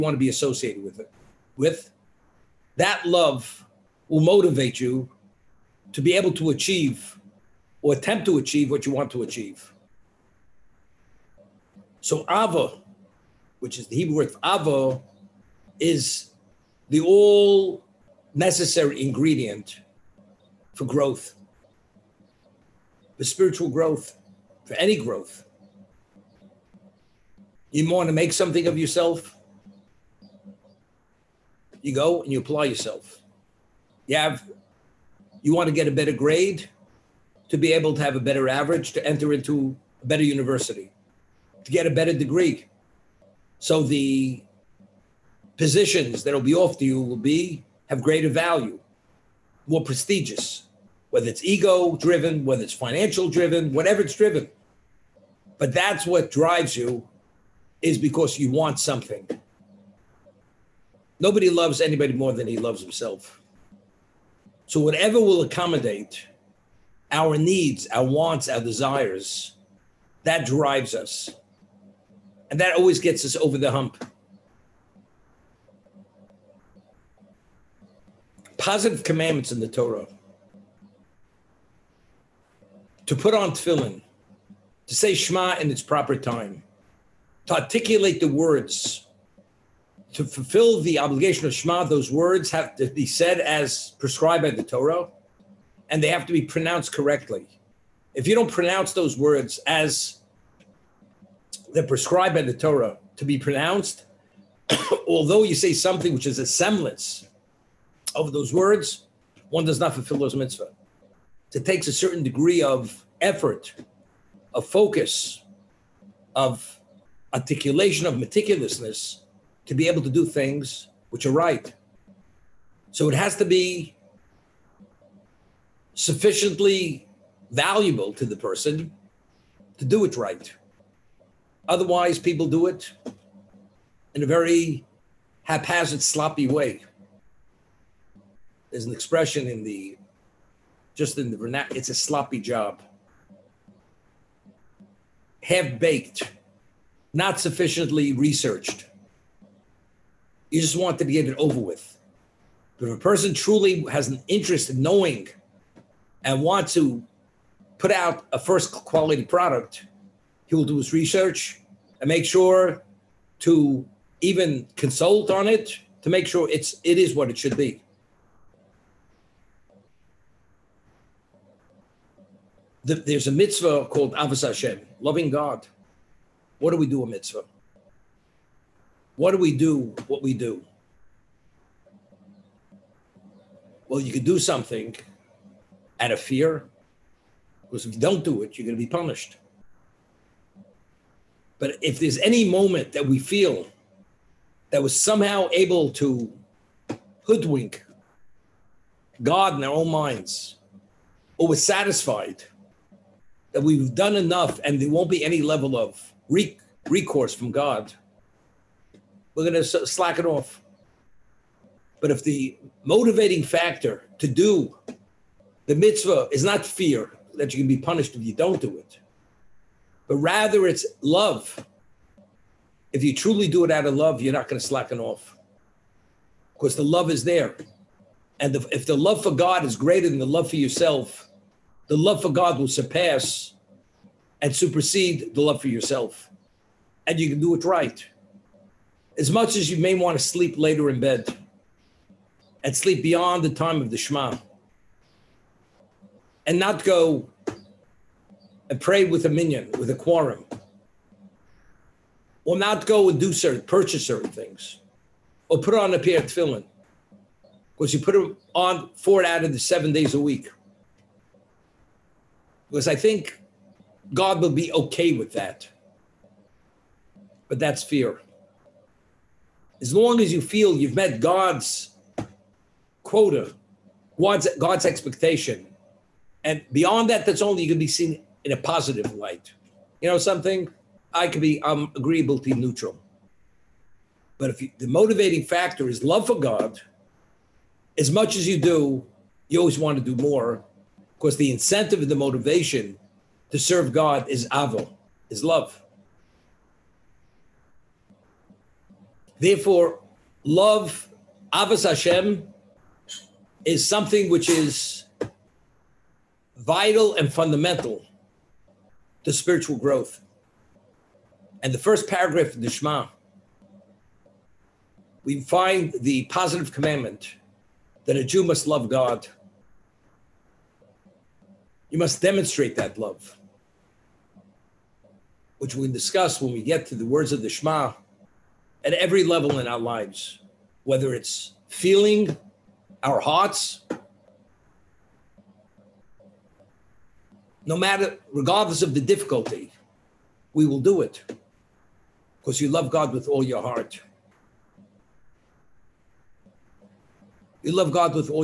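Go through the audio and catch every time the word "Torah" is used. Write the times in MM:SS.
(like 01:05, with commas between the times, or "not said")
01:19, 01:34, 01:42.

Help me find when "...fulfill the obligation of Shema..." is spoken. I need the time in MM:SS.
01:30.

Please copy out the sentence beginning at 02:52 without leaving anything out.
the, there's a mitzvah called Ahavas Hashem, loving God.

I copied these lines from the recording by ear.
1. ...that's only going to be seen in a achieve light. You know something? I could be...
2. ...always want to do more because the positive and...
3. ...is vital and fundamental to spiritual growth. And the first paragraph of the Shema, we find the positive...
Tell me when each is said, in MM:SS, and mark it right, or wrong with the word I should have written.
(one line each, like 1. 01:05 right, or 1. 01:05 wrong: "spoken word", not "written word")
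1. 04:37 wrong: "positive", not "achieve"
2. 04:49 wrong: "incentive", not "positive"
3. 05:04 right.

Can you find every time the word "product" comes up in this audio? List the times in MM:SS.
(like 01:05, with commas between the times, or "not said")
02:39.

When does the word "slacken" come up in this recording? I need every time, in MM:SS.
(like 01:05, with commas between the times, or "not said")
03:29, 03:44.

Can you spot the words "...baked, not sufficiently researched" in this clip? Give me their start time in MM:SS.
02:25.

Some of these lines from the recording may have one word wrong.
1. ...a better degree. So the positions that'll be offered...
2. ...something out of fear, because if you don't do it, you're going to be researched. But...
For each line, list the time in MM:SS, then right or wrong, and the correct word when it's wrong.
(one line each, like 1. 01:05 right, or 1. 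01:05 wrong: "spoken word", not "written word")
1. 00:41 right
2. 03:04 wrong: "punished", not "researched".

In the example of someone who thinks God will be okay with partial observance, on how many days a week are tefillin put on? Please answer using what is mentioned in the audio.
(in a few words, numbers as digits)
4.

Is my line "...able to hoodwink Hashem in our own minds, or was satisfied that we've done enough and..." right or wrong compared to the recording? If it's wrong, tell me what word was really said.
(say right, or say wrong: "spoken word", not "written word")
wrong: "God", not "Hashem".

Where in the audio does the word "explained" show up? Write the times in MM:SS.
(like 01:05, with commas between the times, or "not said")
not said.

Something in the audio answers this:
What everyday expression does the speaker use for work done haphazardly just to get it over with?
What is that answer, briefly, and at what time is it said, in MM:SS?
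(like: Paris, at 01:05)
A sloppy job, at 02:21.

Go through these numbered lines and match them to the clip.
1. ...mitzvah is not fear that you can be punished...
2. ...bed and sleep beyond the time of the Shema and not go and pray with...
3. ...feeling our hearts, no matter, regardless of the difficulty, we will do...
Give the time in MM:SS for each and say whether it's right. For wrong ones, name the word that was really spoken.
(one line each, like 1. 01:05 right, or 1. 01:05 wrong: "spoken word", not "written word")
1. 03:35 right
2. 04:01 right
3. 05:31 right.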